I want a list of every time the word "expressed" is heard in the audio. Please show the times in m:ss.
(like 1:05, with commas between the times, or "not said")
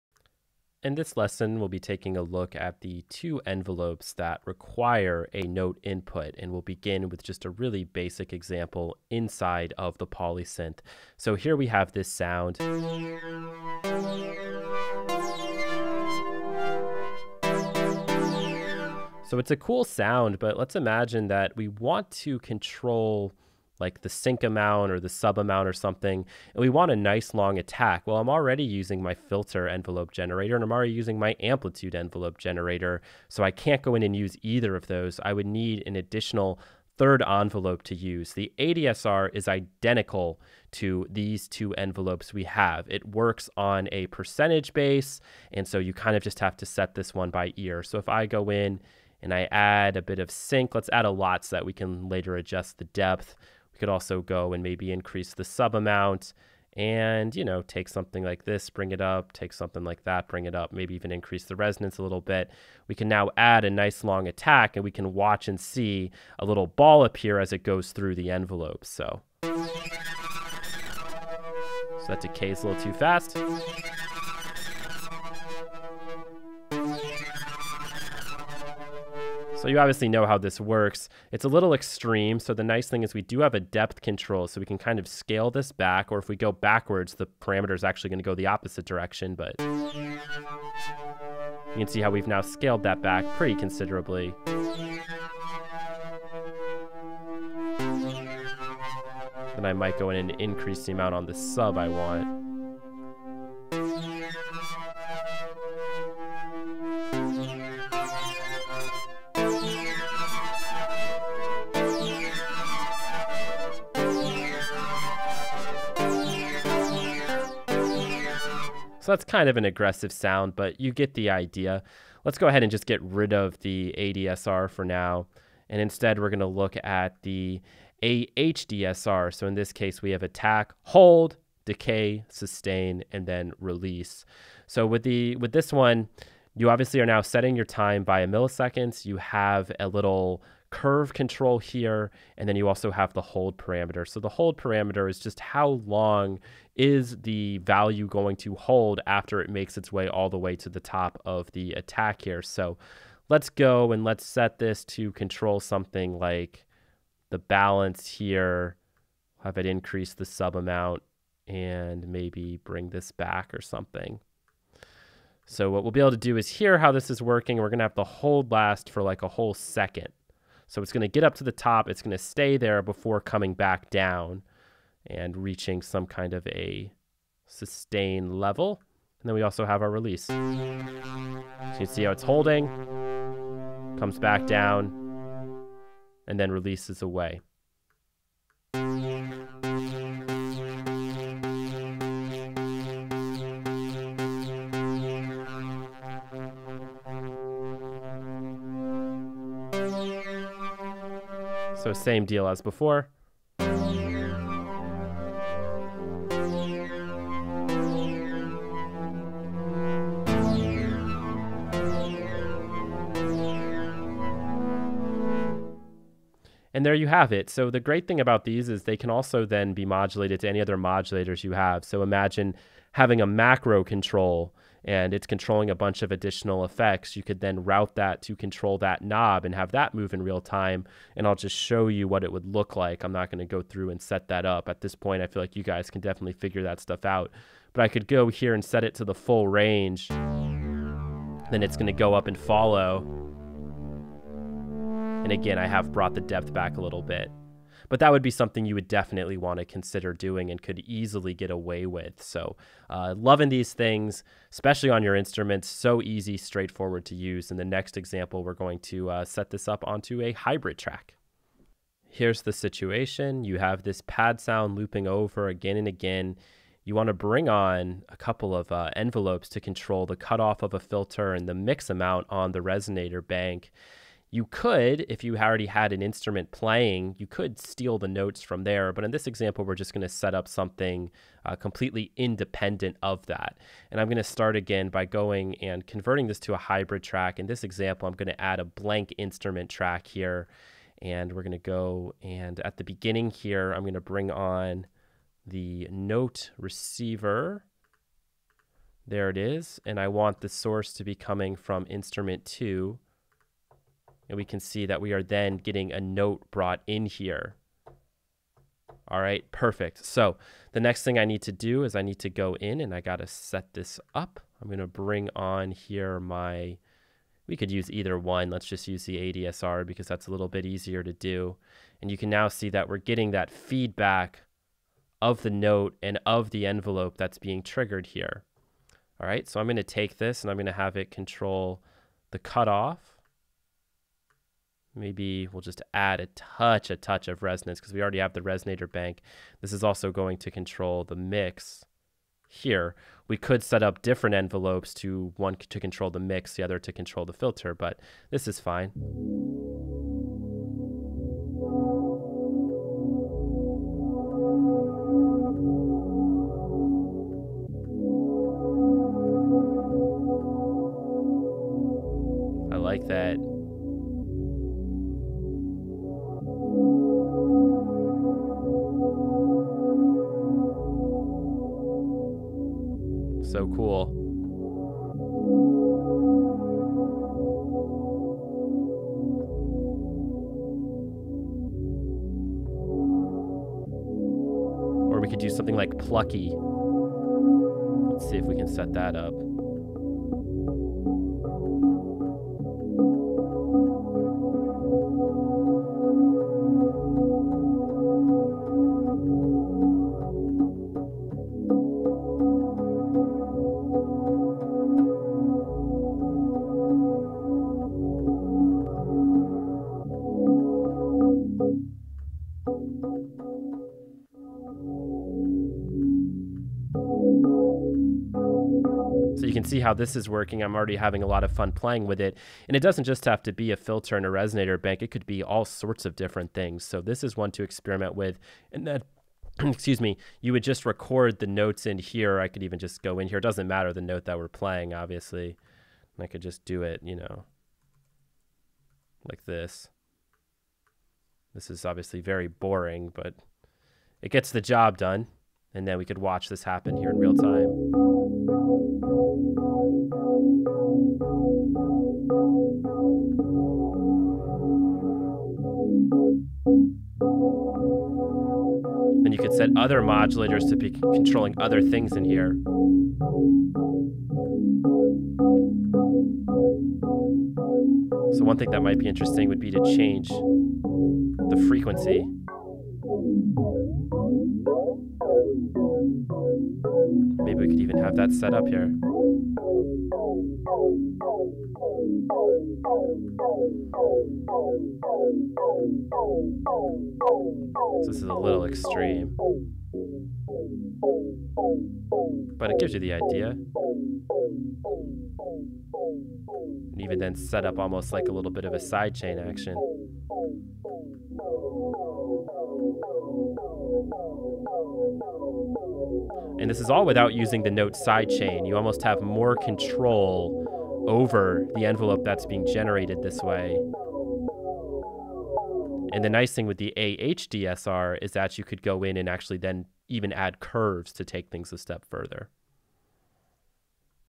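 not said.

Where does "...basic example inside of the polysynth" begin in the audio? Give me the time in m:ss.
0:07.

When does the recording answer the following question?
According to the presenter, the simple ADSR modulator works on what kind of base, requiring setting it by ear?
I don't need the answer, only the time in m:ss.
0:44.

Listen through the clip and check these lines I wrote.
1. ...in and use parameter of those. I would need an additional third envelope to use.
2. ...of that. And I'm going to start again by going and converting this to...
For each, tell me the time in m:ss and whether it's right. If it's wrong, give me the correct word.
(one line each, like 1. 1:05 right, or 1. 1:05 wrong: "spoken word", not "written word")
1. 0:33 wrong: "either", not "parameter"
2. 4:43 right.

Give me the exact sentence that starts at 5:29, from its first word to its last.
All right, so I'm going to take this and I'm going to have it control the cutoff.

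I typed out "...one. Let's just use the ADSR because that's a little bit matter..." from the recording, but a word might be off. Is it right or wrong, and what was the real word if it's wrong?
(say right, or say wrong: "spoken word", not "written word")
wrong: "easier", not "matter".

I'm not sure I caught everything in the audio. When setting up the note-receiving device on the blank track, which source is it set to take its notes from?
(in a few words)
instrument 2.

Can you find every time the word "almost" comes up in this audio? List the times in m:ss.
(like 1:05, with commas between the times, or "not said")
8:17, 8:28.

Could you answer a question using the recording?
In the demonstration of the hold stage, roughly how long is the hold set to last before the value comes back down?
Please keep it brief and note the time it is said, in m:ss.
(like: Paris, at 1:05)
a whole second, at 2:49.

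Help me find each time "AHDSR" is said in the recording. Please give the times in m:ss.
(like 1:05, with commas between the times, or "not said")
2:08, 8:36.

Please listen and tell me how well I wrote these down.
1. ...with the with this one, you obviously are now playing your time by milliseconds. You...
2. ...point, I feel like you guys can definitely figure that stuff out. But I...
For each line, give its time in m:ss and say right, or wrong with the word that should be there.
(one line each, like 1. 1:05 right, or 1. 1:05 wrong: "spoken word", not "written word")
1. 2:14 wrong: "setting", not "playing"
2. 3:54 right.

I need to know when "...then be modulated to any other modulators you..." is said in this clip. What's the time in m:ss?
3:39.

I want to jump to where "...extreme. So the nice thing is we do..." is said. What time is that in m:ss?
1:21.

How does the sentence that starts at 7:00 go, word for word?
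I'm already having a lot of fun playing with it.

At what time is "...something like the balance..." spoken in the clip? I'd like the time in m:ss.
2:35.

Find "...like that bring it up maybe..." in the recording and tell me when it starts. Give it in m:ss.
0:59.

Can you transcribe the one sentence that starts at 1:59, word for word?
So that's kind of an aggressive sound, but you get the idea.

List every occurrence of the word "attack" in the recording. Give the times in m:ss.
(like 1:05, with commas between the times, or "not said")
0:27, 1:04, 2:10, 2:31.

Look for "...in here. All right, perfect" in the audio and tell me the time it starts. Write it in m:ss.
5:06.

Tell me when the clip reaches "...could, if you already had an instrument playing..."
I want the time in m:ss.
4:34.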